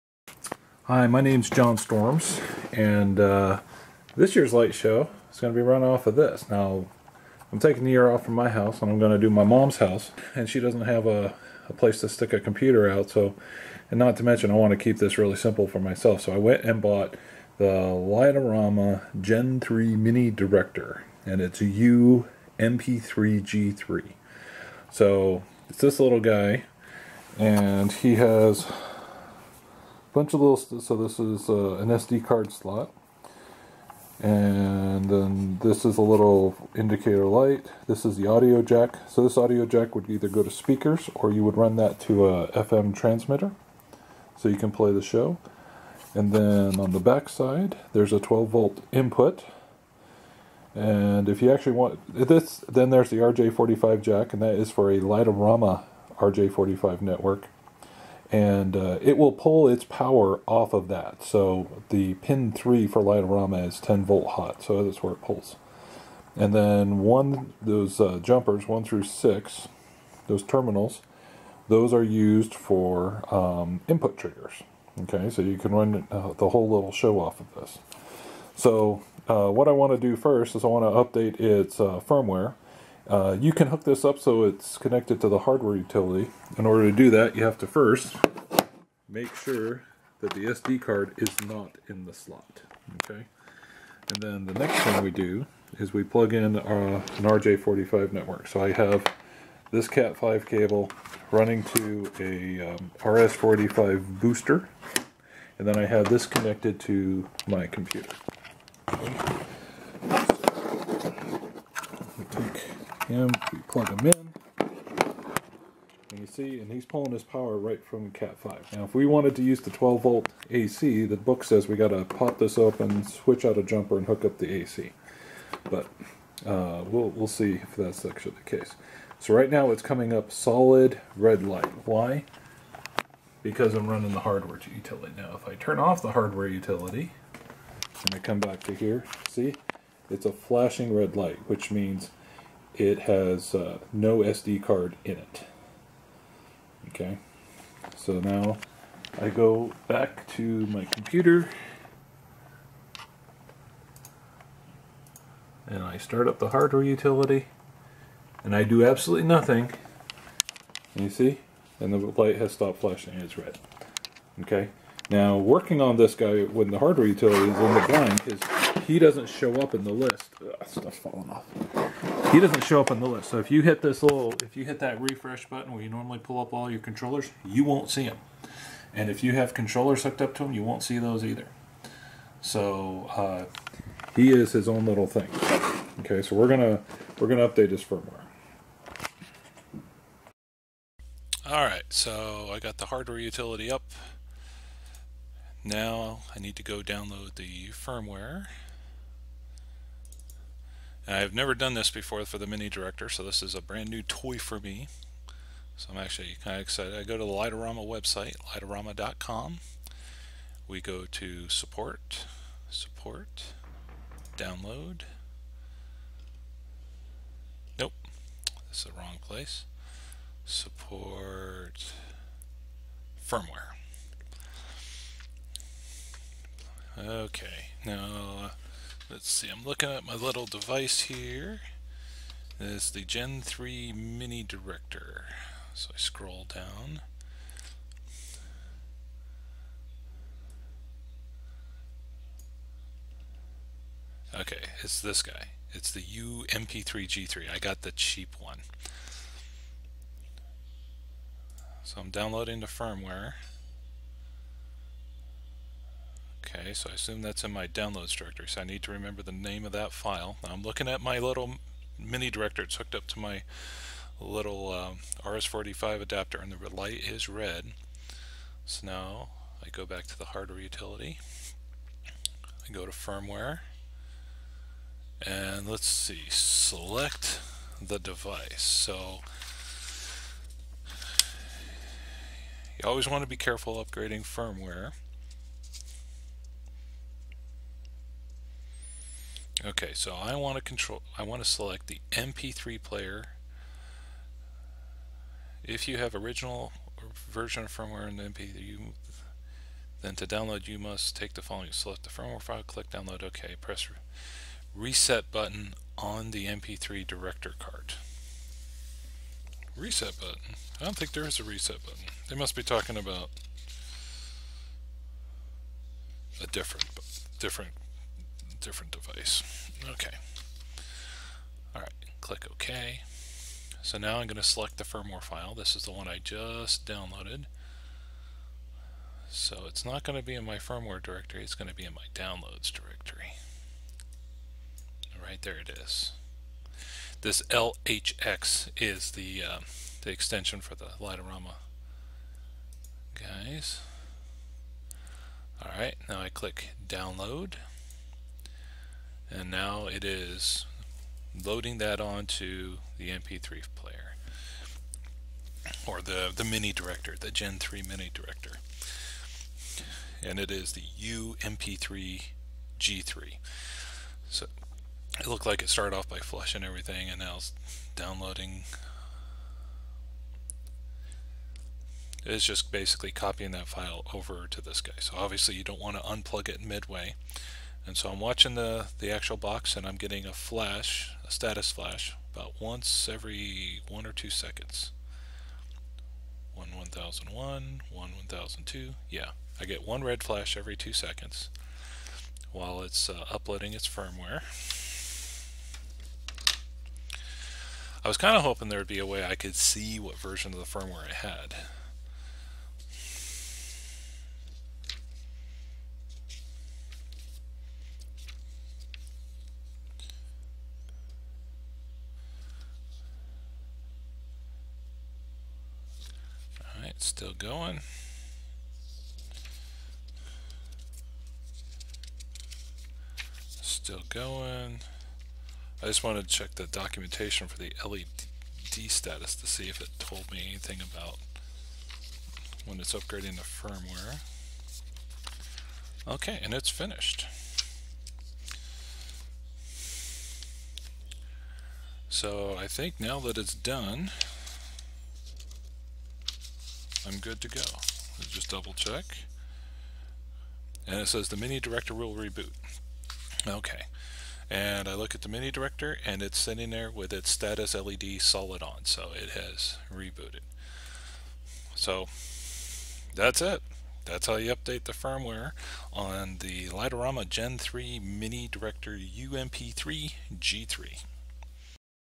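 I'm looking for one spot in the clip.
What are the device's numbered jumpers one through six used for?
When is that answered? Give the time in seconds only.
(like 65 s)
73 s.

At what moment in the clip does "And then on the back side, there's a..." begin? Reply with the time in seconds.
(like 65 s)
46 s.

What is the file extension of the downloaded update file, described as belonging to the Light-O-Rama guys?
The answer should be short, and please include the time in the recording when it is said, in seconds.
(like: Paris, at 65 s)
LHX, at 337 s.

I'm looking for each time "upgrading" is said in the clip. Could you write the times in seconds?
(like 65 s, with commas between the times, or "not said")
283 s, 432 s.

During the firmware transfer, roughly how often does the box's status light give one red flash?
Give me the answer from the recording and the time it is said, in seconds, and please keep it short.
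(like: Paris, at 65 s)
Every 2 seconds, at 390 s.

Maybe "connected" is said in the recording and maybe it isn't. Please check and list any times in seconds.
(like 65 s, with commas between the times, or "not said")
84 s, 106 s.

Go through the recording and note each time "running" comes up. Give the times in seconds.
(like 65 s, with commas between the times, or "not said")
101 s, 133 s.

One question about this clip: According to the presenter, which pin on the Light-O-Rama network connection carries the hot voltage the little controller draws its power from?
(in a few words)
3.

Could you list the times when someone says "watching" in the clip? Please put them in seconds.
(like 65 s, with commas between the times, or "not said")
378 s.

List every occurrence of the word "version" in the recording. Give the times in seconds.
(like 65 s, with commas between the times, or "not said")
297 s, 400 s.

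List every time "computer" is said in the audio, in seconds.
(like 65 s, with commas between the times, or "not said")
12 s, 107 s, 150 s.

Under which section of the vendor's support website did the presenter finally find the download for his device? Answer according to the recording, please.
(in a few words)
Support firmware.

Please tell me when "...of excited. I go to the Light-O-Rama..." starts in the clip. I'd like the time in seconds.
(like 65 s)
206 s.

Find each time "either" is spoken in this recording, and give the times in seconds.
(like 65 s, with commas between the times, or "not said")
40 s, 181 s.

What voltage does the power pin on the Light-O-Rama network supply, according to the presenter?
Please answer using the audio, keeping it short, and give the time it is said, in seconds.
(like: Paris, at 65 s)
10 volt, at 63 s.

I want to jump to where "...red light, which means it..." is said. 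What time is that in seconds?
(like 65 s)
140 s.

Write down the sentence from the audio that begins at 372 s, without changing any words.
It's just basically copying that file over to this guy.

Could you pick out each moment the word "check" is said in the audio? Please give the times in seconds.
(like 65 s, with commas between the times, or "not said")
426 s, 448 s.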